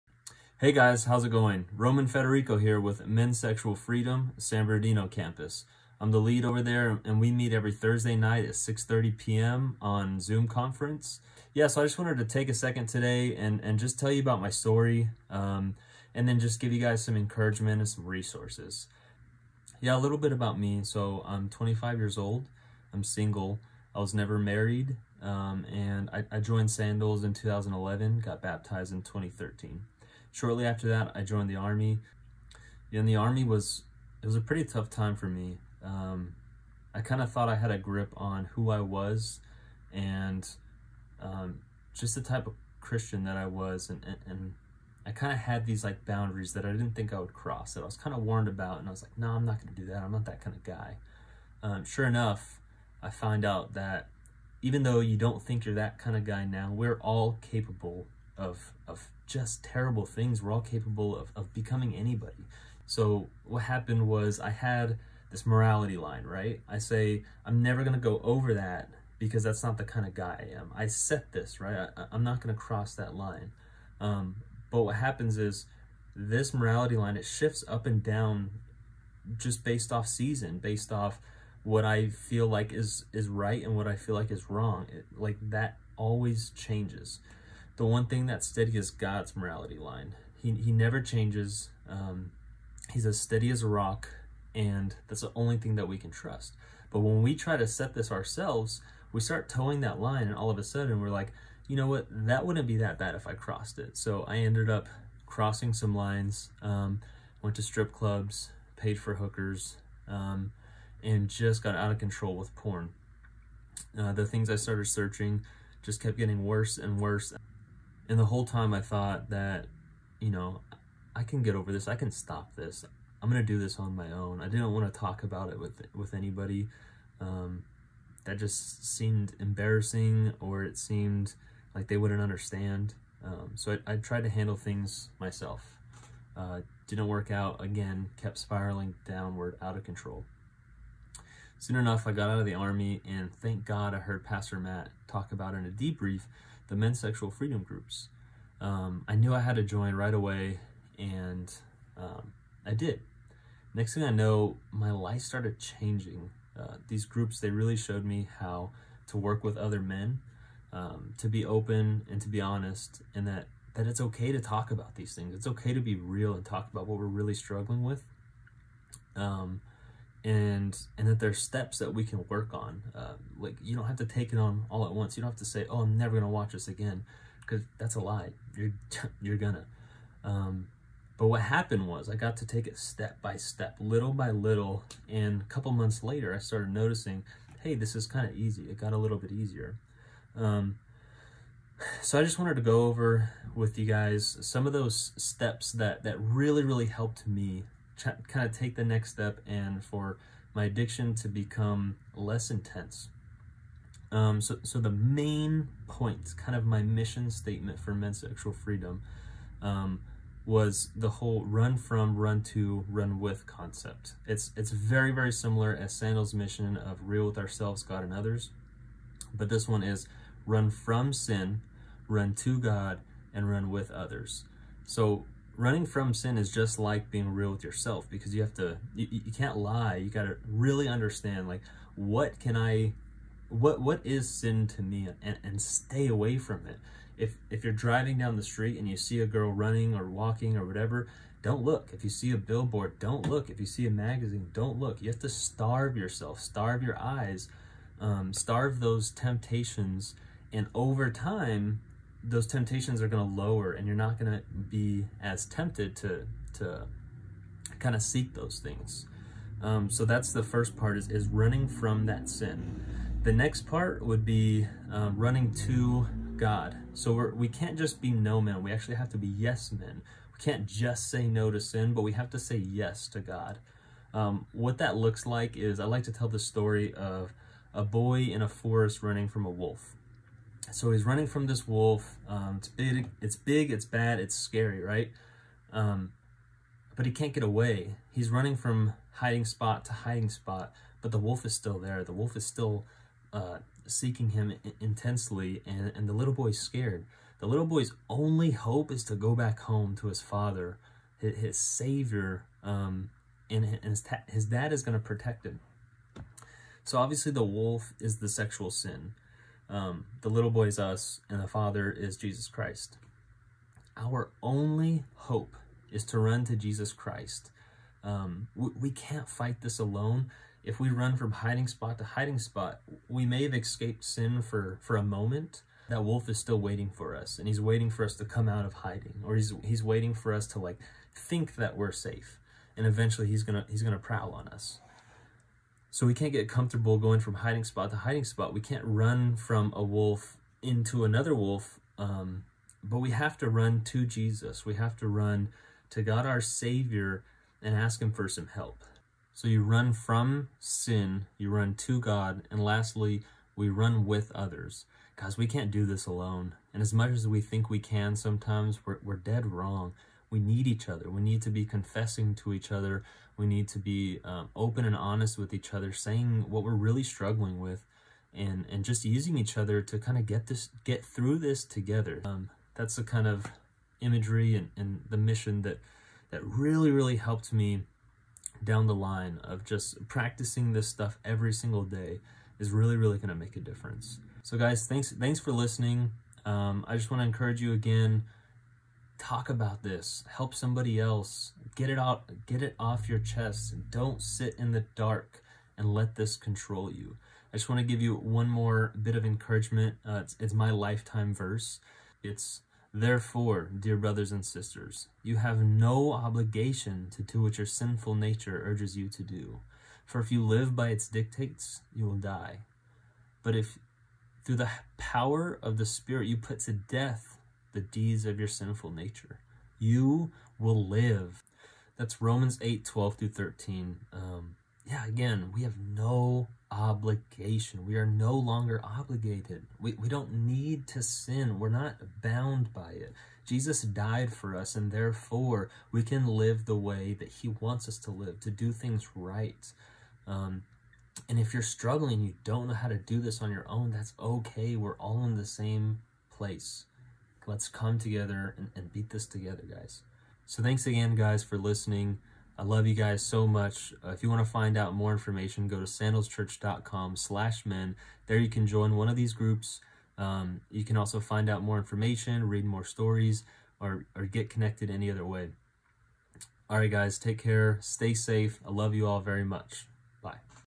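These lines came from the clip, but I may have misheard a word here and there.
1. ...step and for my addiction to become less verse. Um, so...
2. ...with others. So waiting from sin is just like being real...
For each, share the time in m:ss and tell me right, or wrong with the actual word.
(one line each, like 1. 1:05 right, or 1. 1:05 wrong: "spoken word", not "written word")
1. 3:19 wrong: "intense", not "verse"
2. 3:43 wrong: "running", not "waiting".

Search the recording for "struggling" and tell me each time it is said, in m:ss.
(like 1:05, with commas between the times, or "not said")
2:47, 6:07, 7:21.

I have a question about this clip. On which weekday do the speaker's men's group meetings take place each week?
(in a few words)
Thursday.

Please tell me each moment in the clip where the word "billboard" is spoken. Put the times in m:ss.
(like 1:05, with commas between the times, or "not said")
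4:02.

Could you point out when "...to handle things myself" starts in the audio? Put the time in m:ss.
2:14.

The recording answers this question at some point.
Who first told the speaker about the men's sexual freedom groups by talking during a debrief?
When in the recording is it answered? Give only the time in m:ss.
2:24.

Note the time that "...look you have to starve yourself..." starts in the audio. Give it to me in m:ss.
4:04.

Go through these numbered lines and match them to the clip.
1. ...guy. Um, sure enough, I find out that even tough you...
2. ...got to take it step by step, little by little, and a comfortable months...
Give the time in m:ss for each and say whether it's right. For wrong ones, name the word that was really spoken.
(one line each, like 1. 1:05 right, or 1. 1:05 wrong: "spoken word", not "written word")
1. 0:50 wrong: "though", not "tough"
2. 3:02 wrong: "couple", not "comfortable".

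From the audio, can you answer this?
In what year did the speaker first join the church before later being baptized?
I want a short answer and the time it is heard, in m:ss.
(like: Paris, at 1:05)
2011, at 0:27.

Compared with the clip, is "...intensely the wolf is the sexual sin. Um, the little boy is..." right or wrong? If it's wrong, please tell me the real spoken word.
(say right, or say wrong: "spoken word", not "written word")
wrong: "obviously", not "intensely".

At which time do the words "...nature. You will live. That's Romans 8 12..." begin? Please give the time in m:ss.
6:58.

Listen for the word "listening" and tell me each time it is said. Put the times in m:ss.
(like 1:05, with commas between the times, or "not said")
6:25, 7:31.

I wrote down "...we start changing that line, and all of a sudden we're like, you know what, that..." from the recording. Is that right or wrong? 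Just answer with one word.
wrong.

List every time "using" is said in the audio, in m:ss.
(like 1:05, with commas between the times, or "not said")
6:09.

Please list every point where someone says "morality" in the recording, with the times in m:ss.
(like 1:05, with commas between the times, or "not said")
1:05, 1:16, 1:29.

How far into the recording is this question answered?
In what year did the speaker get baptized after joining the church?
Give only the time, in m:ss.
0:29.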